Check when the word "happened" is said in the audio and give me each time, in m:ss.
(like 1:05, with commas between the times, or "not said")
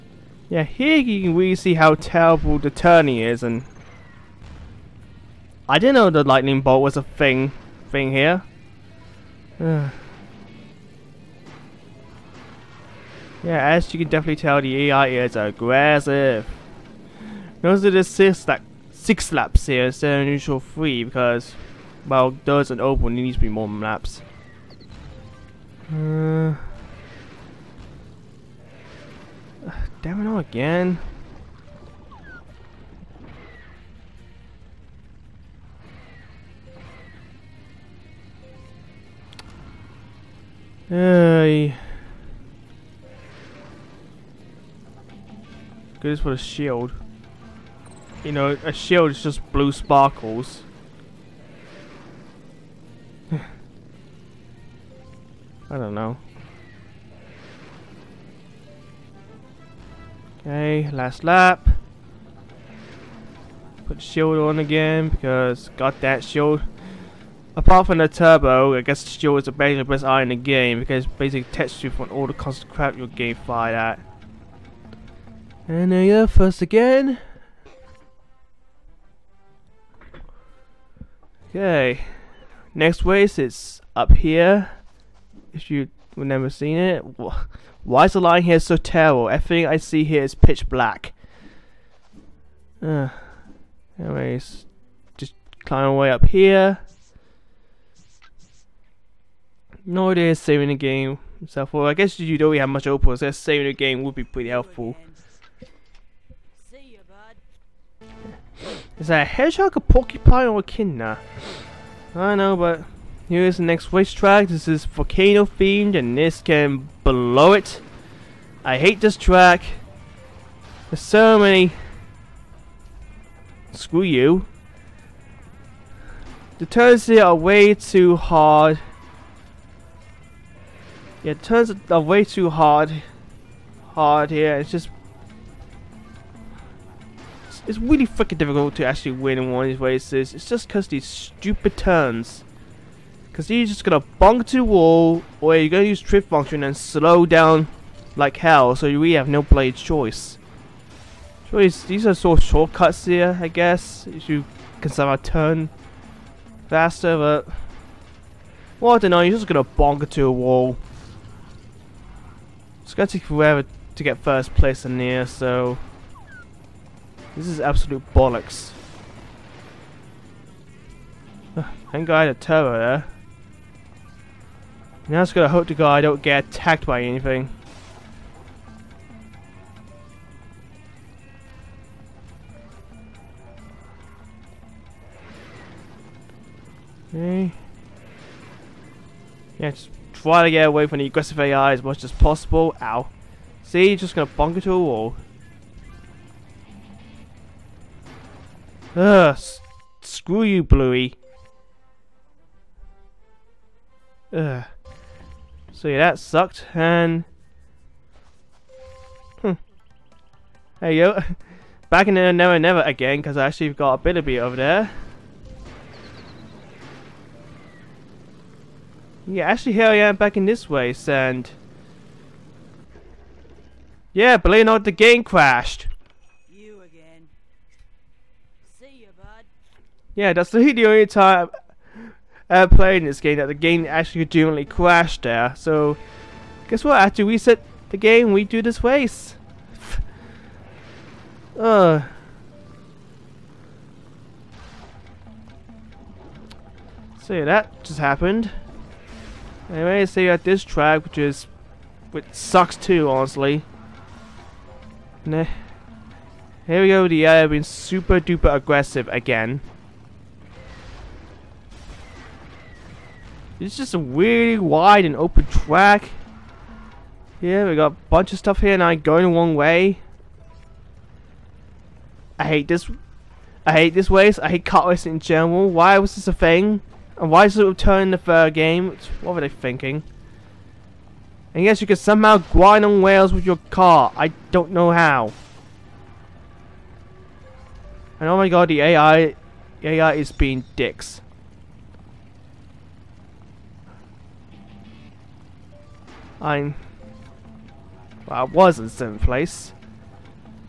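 4:07.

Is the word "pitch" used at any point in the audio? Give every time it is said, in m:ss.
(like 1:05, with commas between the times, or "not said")
1:30.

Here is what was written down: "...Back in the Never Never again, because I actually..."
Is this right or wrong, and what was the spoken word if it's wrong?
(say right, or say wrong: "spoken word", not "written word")
right.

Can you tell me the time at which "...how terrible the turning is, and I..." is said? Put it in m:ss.
0:01.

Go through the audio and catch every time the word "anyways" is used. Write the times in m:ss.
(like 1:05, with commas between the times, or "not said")
1:33, 4:09.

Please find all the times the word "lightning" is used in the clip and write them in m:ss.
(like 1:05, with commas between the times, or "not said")
0:06.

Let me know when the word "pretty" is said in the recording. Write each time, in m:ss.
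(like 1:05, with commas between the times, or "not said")
1:44.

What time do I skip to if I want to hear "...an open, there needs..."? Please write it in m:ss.
0:22.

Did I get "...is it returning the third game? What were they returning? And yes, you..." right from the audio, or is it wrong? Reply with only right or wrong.
wrong.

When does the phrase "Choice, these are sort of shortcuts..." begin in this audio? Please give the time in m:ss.
2:31.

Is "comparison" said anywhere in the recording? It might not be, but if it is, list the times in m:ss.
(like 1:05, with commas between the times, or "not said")
not said.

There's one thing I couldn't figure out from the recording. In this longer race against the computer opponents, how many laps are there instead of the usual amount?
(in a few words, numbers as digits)
6.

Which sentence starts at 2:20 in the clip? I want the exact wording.
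It's just because these stupid turns.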